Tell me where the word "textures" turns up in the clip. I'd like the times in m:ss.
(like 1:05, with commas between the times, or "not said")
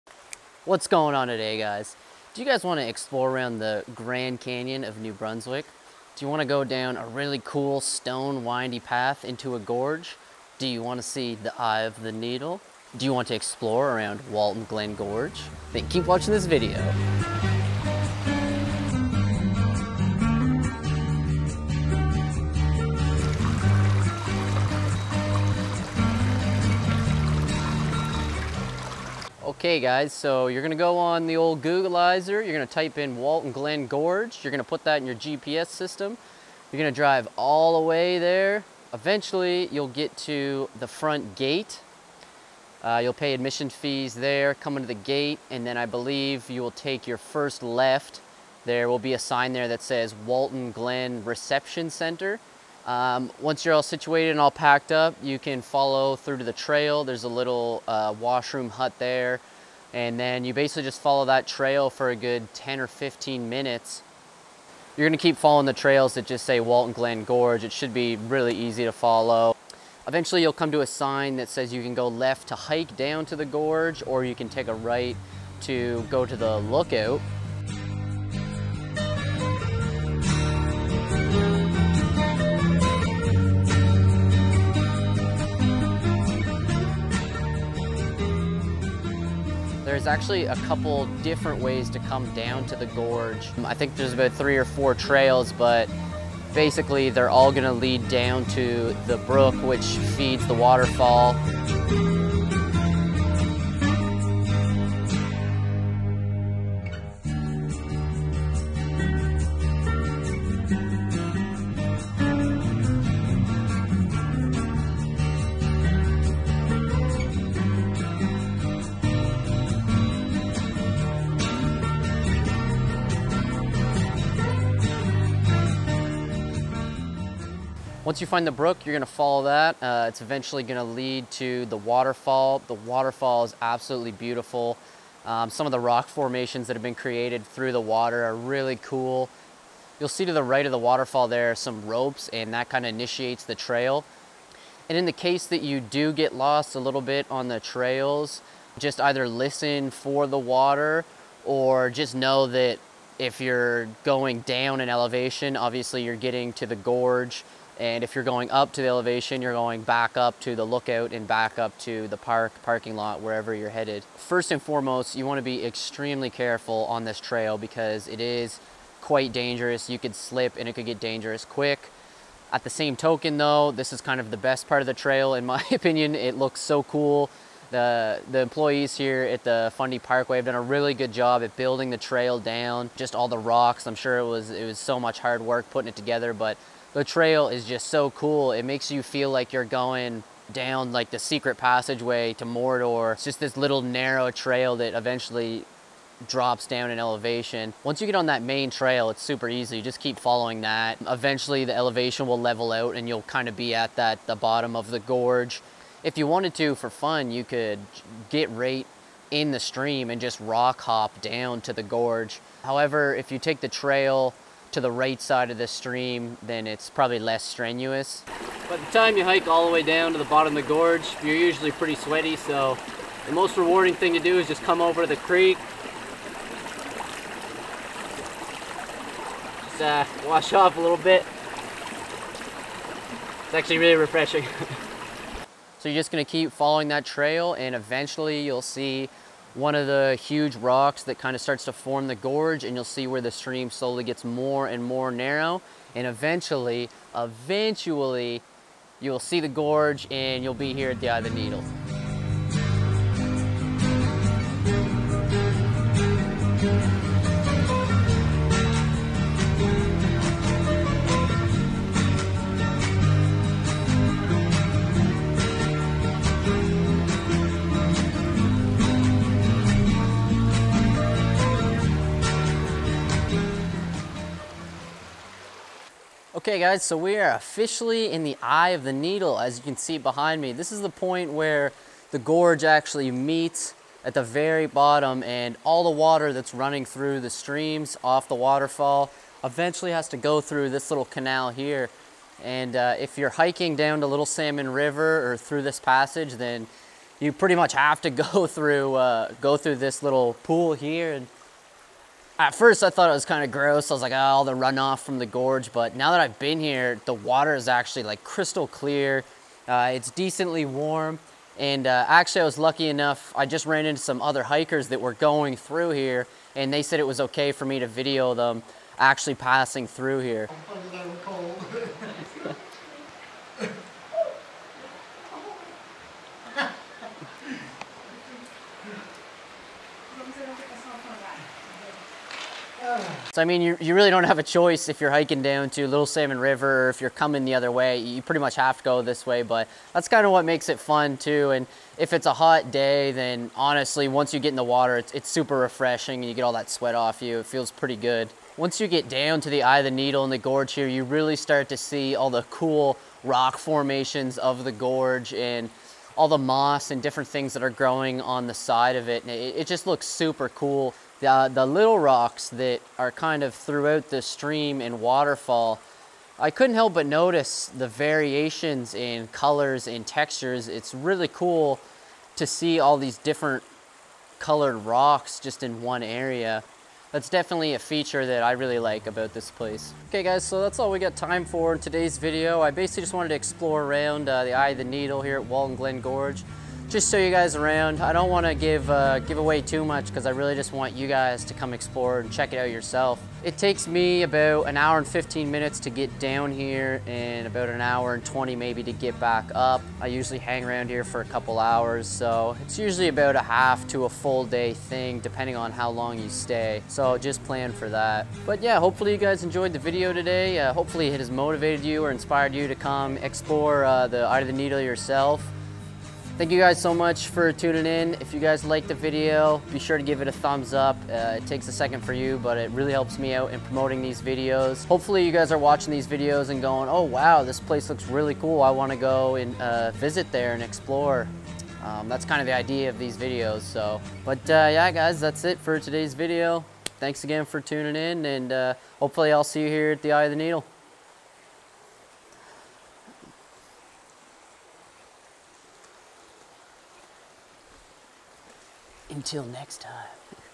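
6:10.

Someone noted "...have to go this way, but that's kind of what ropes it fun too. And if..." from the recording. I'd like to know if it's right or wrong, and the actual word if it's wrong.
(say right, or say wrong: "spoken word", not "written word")
wrong: "makes", not "ropes".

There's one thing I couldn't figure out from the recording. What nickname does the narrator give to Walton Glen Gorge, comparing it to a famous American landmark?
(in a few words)
Grand Canyon of New Brunswick.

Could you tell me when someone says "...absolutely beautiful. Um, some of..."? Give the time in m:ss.
2:13.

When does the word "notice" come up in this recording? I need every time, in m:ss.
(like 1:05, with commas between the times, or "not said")
6:07.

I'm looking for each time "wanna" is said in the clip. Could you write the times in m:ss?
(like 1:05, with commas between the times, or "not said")
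2:45, 7:08.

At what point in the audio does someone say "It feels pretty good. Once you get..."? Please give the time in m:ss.
5:47.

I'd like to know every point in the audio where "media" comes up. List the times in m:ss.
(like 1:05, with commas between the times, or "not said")
not said.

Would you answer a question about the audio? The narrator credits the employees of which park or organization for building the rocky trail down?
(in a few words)
Fundy Parkway.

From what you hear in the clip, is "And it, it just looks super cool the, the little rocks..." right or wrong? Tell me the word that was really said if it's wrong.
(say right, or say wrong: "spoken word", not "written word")
right.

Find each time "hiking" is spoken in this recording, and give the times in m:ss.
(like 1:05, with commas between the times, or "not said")
4:53, 5:35.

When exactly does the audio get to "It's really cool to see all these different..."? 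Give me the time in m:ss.
6:10.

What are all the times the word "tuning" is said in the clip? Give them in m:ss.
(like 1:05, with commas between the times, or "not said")
6:57, 7:17.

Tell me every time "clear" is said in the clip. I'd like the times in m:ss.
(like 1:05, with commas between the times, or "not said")
5:08.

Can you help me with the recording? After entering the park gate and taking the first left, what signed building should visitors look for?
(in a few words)
Walton Glen Reception Center.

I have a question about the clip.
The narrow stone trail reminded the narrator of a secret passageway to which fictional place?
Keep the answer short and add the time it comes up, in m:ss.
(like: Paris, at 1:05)
Mordor, at 3:12.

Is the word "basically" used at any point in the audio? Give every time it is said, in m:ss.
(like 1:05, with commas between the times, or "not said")
1:00, 1:36, 6:22.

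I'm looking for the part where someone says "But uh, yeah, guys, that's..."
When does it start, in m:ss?
7:14.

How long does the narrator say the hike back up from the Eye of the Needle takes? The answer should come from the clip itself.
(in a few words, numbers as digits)
About 1 hour 20 minutes.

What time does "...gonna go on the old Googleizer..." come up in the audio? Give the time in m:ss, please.
0:30.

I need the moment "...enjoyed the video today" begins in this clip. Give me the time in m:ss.
6:49.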